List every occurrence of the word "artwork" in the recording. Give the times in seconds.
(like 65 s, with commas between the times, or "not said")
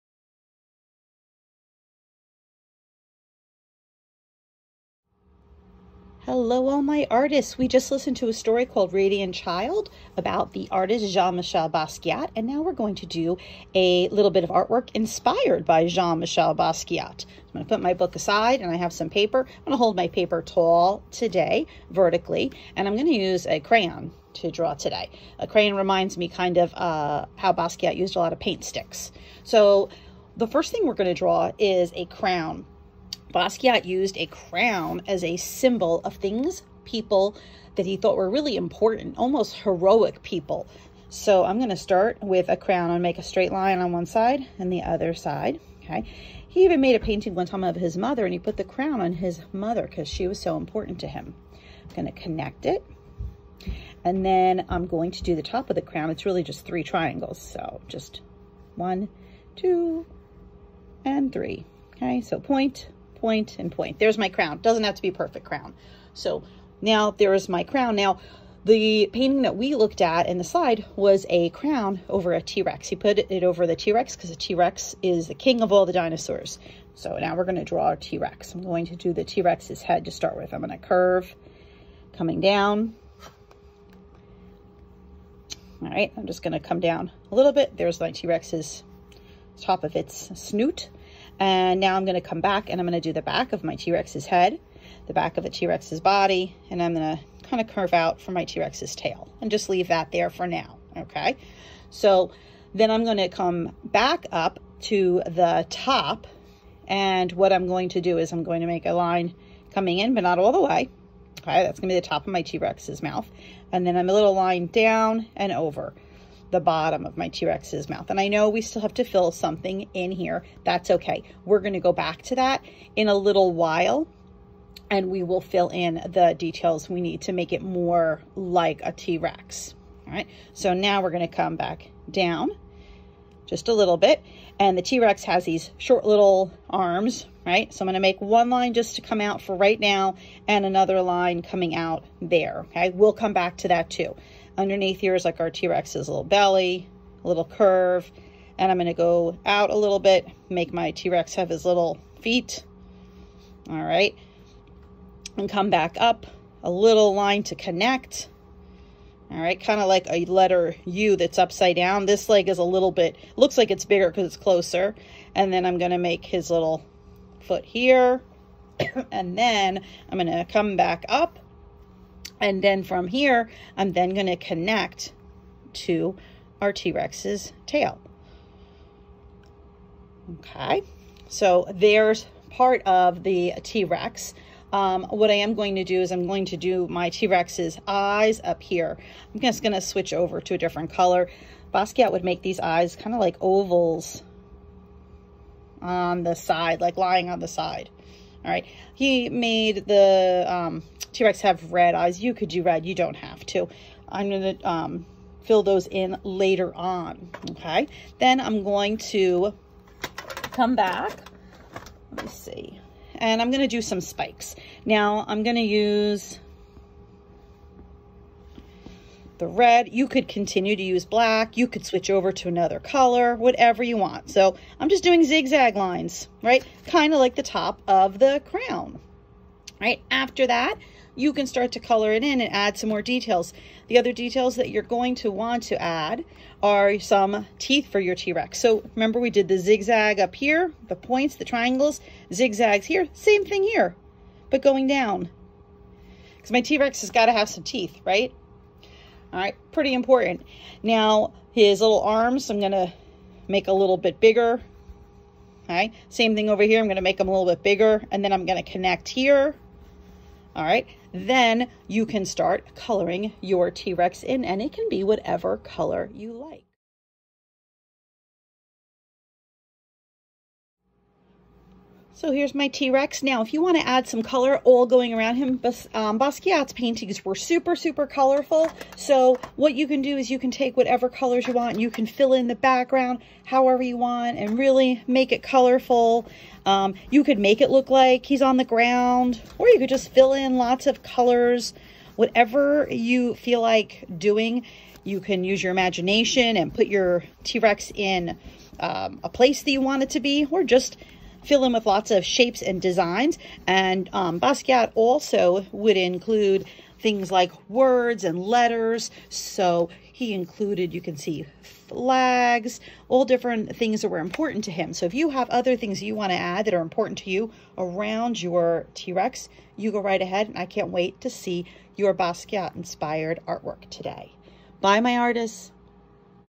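14 s, 323 s.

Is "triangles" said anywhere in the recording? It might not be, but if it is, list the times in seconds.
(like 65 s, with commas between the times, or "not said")
56 s, 241 s.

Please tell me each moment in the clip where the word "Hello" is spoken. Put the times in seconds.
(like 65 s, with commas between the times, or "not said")
6 s.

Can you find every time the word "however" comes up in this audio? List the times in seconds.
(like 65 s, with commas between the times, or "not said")
283 s.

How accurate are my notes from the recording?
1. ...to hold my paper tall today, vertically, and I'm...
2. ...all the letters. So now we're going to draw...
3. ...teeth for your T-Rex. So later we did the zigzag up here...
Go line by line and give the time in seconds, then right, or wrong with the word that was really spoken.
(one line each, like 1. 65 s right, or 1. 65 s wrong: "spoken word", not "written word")
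1. 19 s right
2. 75 s wrong: "dinosaurs", not "letters"
3. 237 s wrong: "remember", not "later".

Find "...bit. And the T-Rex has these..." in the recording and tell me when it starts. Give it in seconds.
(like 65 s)
133 s.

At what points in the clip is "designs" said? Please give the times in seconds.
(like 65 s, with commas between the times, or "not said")
302 s.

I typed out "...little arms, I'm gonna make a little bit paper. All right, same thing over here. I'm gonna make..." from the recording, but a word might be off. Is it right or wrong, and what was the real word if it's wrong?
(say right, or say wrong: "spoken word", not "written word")
wrong: "bigger", not "paper".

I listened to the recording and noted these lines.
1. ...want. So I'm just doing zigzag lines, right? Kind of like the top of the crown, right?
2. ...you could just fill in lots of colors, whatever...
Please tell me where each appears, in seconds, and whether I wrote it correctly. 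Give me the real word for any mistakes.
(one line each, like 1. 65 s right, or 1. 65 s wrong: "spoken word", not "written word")
1. 223 s right
2. 289 s right.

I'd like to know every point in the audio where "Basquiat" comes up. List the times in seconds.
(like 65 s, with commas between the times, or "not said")
11 s, 16 s, 27 s, 33 s, 191 s, 276 s, 304 s, 322 s.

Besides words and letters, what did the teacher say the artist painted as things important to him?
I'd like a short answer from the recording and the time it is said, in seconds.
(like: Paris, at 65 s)
flags, at 311 s.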